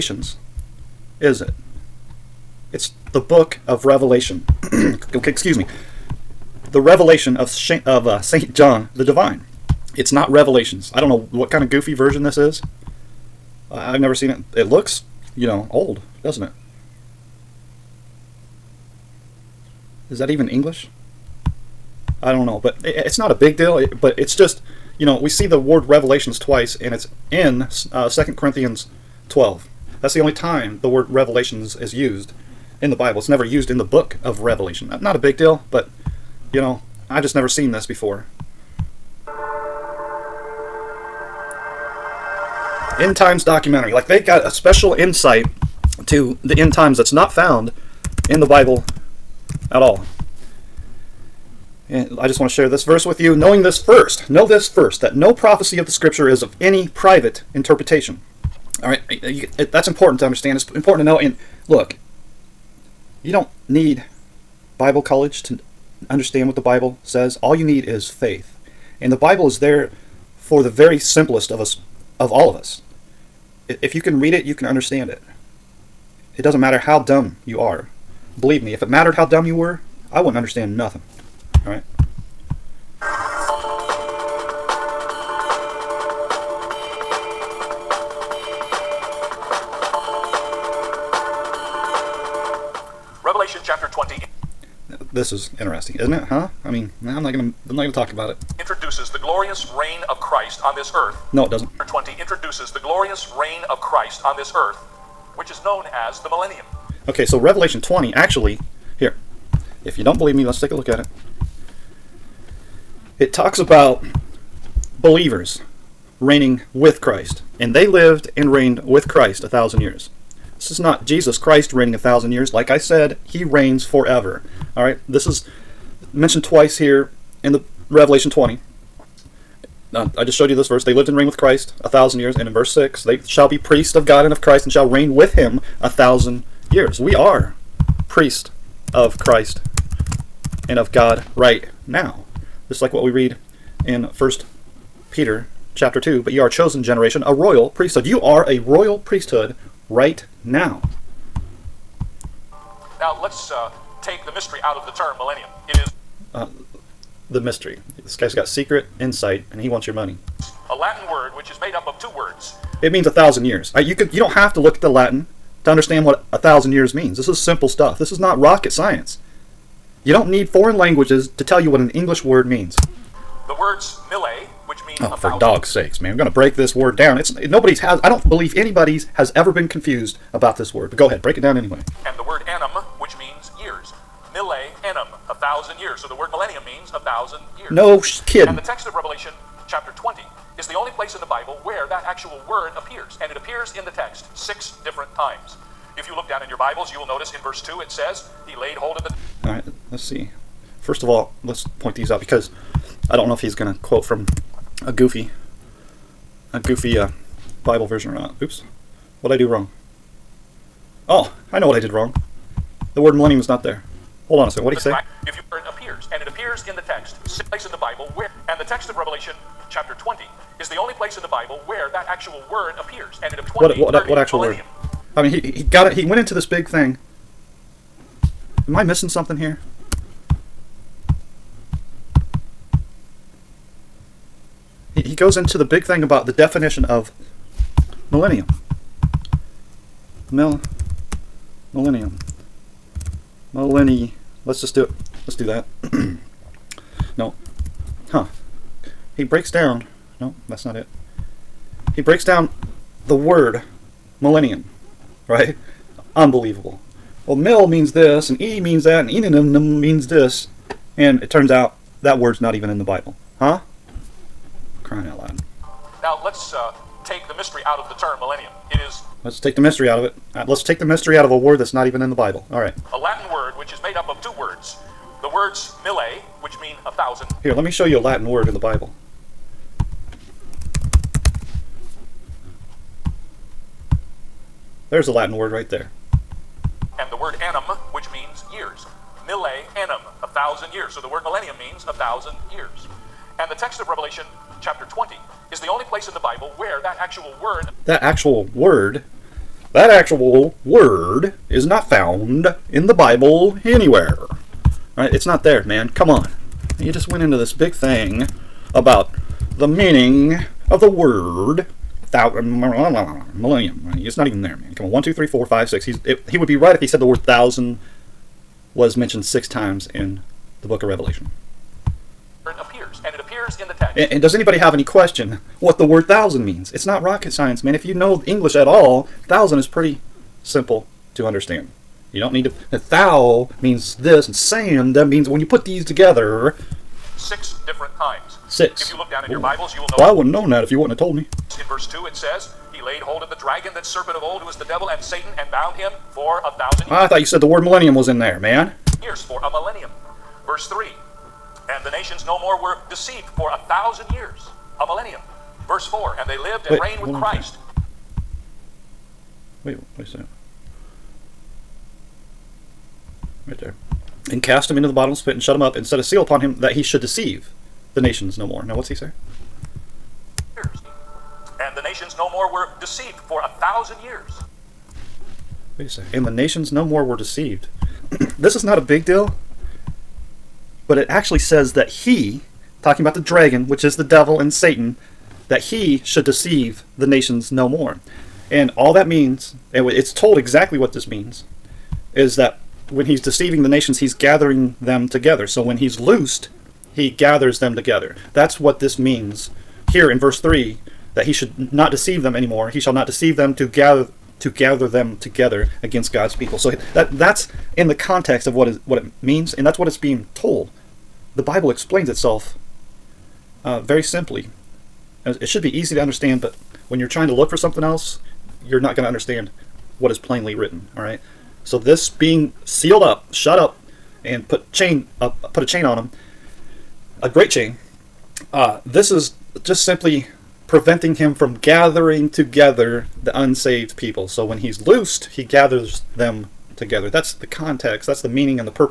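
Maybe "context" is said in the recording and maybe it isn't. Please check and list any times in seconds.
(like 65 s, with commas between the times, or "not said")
407 s, 437 s.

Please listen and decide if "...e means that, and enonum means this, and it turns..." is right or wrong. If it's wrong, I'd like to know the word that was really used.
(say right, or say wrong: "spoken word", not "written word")
right.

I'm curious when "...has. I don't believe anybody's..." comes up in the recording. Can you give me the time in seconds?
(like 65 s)
177 s.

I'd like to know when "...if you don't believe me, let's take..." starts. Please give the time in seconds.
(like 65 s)
109 s.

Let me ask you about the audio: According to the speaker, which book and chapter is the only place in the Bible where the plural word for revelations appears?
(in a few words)
Second Corinthians 12.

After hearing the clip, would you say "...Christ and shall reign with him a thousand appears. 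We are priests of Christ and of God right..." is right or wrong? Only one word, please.
wrong.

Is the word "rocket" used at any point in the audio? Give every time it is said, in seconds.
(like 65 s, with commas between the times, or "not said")
168 s, 327 s.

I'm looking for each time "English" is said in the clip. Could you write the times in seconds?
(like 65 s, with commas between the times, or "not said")
20 s, 171 s, 328 s.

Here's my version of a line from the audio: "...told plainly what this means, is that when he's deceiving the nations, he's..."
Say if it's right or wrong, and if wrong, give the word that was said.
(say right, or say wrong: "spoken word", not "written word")
wrong: "exactly", not "plainly".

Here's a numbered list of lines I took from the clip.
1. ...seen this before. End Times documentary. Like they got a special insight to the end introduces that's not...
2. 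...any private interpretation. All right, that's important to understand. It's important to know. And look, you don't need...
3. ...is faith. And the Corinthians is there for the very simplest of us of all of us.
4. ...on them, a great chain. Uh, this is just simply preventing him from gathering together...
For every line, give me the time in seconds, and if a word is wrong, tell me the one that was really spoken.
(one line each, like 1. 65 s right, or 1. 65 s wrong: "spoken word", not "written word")
1. 37 s wrong: "times", not "introduces"
2. 56 s right
3. 67 s wrong: "Bible", not "Corinthians"
4. 425 s right.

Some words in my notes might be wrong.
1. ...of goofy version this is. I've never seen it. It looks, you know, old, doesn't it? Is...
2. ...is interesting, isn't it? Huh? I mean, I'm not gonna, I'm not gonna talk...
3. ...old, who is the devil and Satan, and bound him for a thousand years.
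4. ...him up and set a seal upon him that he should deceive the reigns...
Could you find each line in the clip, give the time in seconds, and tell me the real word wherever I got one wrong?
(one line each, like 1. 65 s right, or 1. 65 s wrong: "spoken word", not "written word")
1. 11 s right
2. 95 s right
3. 344 s right
4. 365 s wrong: "nations", not "reigns".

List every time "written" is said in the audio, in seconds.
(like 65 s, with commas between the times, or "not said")
420 s.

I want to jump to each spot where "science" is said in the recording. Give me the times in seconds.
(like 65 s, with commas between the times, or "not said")
168 s, 327 s.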